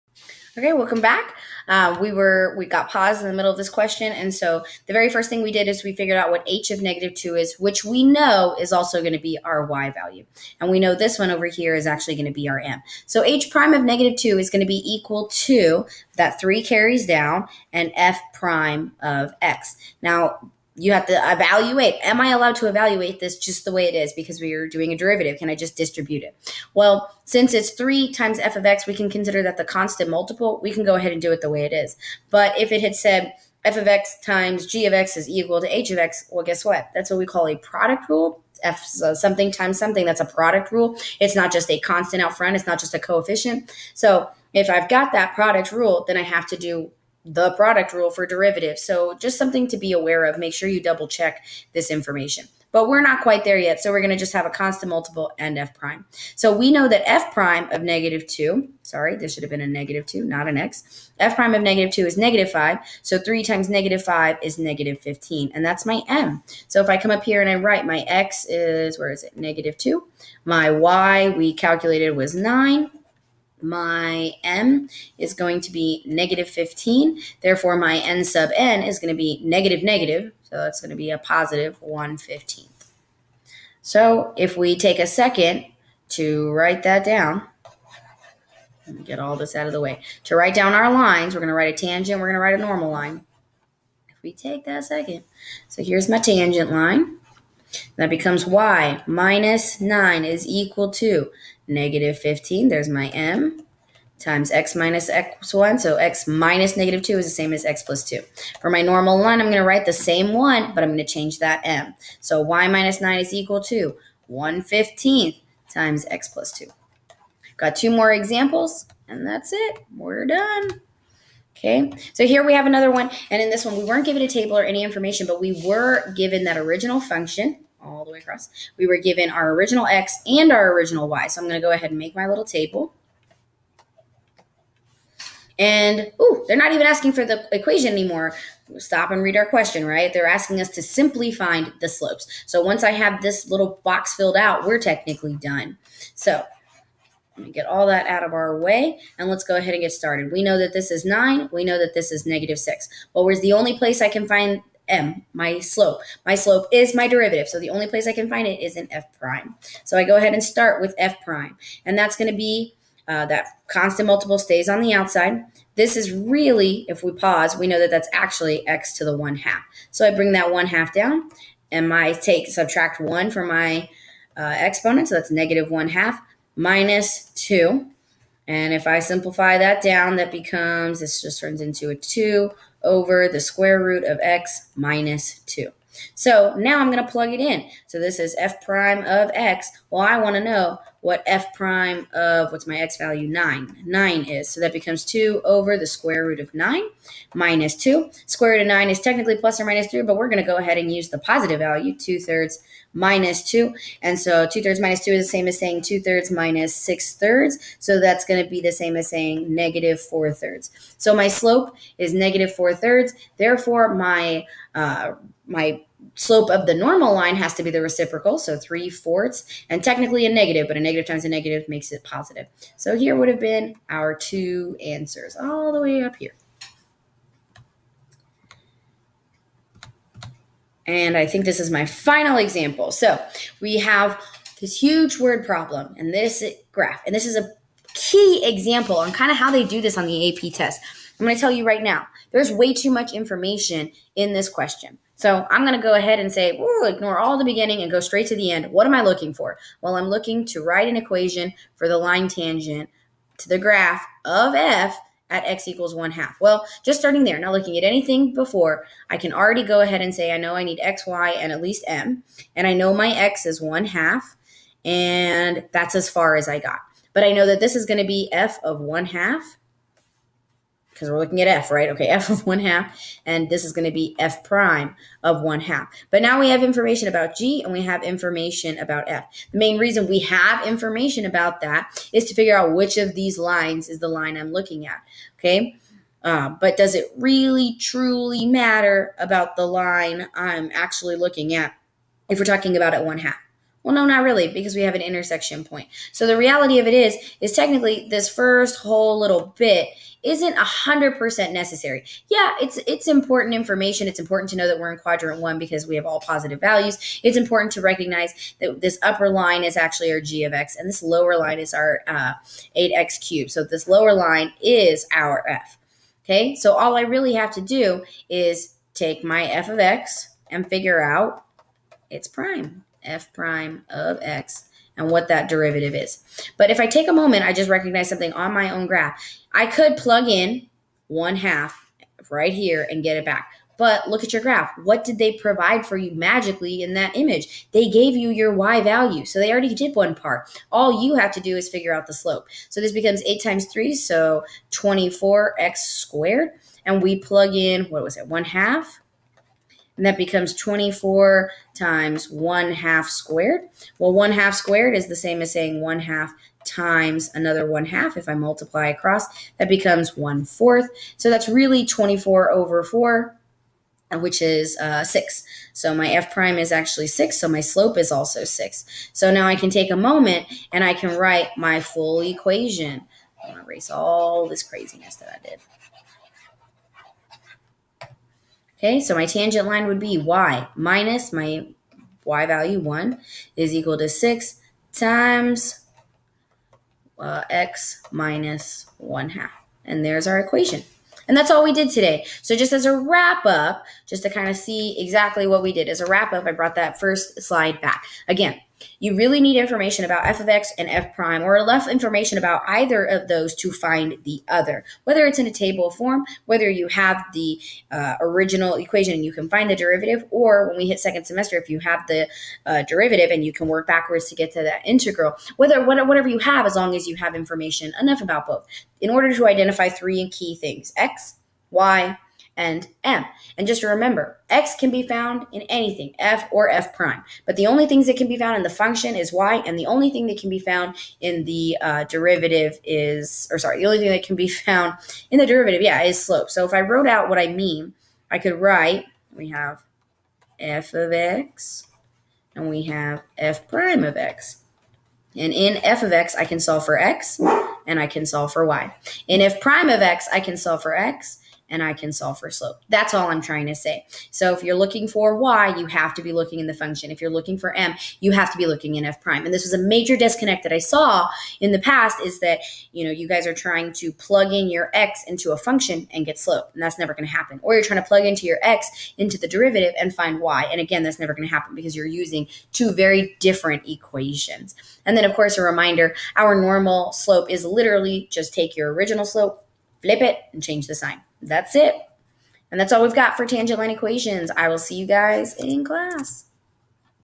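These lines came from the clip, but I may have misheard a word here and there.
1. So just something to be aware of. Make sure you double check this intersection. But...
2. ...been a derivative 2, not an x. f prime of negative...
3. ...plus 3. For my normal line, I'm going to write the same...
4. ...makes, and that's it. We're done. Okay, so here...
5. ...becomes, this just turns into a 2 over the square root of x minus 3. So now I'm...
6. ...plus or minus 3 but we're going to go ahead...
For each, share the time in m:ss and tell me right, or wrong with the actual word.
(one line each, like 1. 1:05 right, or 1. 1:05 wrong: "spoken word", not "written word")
1. 0:48 wrong: "information", not "intersection"
2. 0:59 wrong: "negative", not "derivative"
3. 1:47 wrong: "2", not "3"
4. 1:58 wrong: "examples", not "makes"
5. 3:00 wrong: "2", not "3"
6. 3:19 right.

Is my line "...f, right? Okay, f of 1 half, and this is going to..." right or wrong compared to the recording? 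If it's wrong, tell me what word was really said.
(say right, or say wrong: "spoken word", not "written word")
right.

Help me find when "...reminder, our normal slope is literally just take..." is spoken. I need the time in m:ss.
7:55.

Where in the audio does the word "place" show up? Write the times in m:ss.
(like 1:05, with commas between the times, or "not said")
2:33, 2:37.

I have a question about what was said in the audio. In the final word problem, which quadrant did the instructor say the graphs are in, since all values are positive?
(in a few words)
quadrant 1.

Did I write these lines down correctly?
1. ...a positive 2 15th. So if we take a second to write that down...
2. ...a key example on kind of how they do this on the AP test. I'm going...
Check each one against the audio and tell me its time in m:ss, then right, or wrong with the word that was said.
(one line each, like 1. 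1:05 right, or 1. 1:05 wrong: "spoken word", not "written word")
1. 1:21 wrong: "1", not "2"
2. 3:57 right.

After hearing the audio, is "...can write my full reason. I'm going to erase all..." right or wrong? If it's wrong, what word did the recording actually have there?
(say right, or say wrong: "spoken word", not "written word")
wrong: "equation", not "reason".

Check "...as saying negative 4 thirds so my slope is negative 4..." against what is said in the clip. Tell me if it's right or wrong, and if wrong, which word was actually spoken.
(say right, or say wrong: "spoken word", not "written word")
right.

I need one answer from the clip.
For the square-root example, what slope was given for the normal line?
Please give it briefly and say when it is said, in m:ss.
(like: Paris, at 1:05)
3/4, at 3:38.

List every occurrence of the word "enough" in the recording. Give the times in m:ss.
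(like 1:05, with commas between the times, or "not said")
6:41, 6:58.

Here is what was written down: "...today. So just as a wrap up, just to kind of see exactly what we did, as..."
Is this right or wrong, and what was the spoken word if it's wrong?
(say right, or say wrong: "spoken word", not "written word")
right.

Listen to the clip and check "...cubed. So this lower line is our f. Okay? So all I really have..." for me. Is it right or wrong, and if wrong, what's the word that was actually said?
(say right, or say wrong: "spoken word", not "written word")
right.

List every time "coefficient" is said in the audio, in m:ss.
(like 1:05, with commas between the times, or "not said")
0:42.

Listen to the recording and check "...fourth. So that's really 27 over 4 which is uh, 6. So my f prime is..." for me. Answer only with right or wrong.
wrong.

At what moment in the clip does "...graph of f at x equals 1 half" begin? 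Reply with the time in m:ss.
4:13.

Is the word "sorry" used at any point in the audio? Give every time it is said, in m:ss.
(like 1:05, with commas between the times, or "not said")
0:58, 7:13.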